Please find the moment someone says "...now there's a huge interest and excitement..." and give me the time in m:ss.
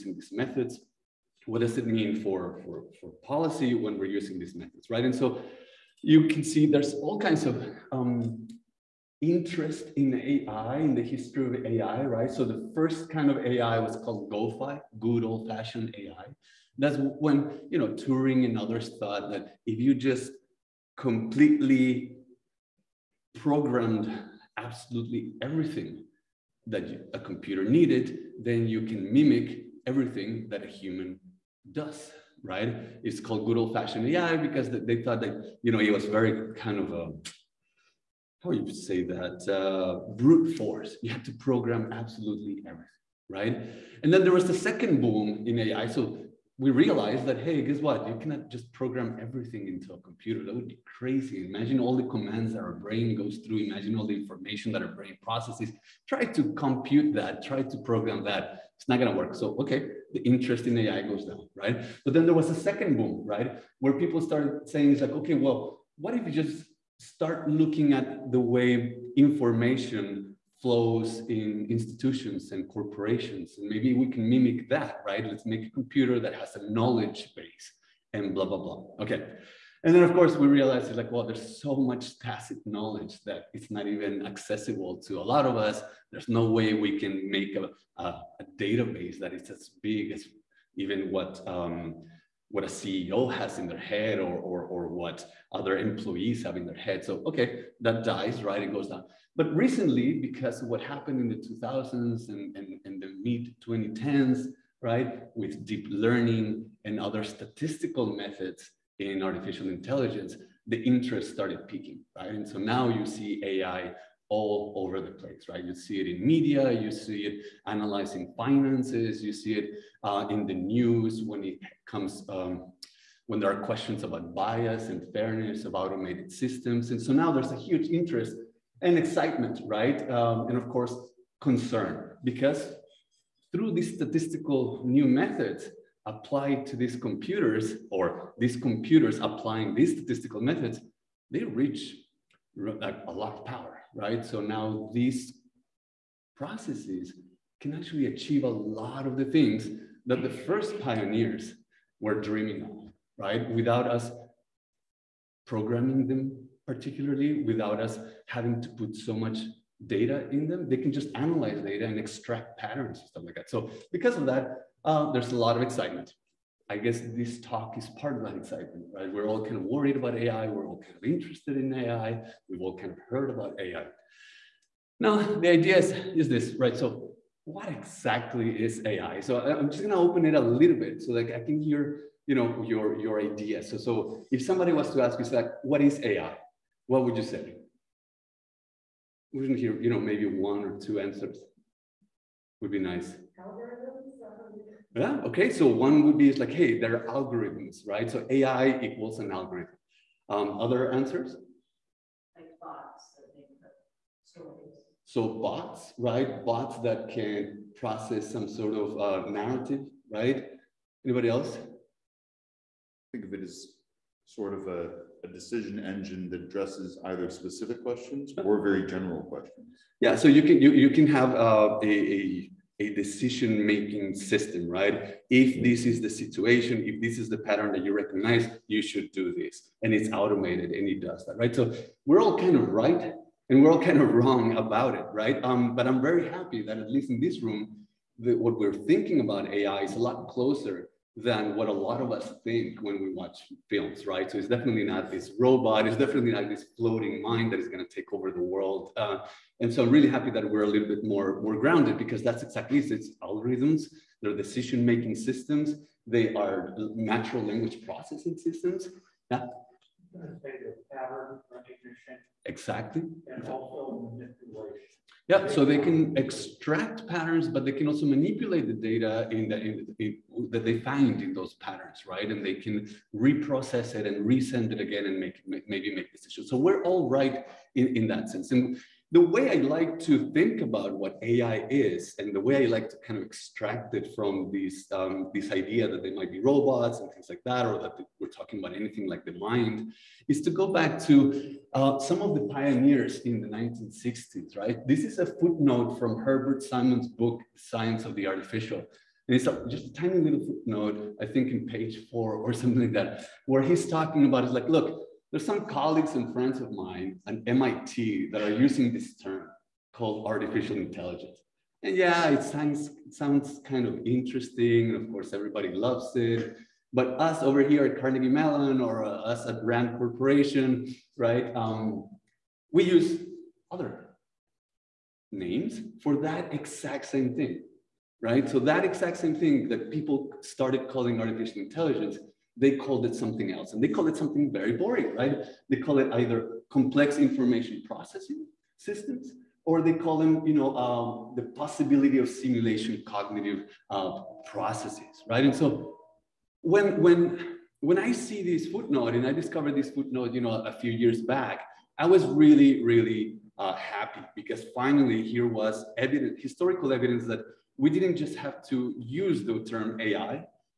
2:07.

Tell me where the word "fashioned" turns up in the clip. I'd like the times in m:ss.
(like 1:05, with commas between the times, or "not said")
0:15, 0:33.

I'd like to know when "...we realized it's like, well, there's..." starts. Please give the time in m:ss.
1:20.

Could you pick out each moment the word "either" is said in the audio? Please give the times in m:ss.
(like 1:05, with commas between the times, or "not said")
3:37, 5:36.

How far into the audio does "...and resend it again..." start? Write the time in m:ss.
4:34.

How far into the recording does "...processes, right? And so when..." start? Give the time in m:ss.
5:44.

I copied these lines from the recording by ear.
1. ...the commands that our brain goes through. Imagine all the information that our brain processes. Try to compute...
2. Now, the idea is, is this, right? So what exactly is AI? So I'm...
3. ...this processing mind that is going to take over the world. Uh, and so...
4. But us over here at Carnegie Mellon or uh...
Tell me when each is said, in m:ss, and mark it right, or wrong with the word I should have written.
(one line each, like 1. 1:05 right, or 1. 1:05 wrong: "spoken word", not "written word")
1. 0:51 right
2. 2:55 right
3. 4:06 wrong: "floating", not "processing"
4. 5:16 right.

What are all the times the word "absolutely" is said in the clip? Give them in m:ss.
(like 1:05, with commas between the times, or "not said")
0:24, 0:41.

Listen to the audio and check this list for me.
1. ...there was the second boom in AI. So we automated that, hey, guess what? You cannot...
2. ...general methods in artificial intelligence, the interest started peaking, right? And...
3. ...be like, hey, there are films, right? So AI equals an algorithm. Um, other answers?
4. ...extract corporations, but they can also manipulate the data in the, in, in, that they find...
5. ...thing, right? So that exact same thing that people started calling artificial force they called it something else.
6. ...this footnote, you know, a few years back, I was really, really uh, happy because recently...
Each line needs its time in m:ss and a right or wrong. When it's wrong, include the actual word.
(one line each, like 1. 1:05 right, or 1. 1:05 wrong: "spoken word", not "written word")
1. 0:44 wrong: "realized", not "automated"
2. 1:47 wrong: "statistical", not "general"
3. 3:16 wrong: "algorithms", not "films"
4. 4:26 wrong: "patterns", not "corporations"
5. 5:27 wrong: "intelligence", not "force"
6. 5:49 wrong: "finally", not "recently".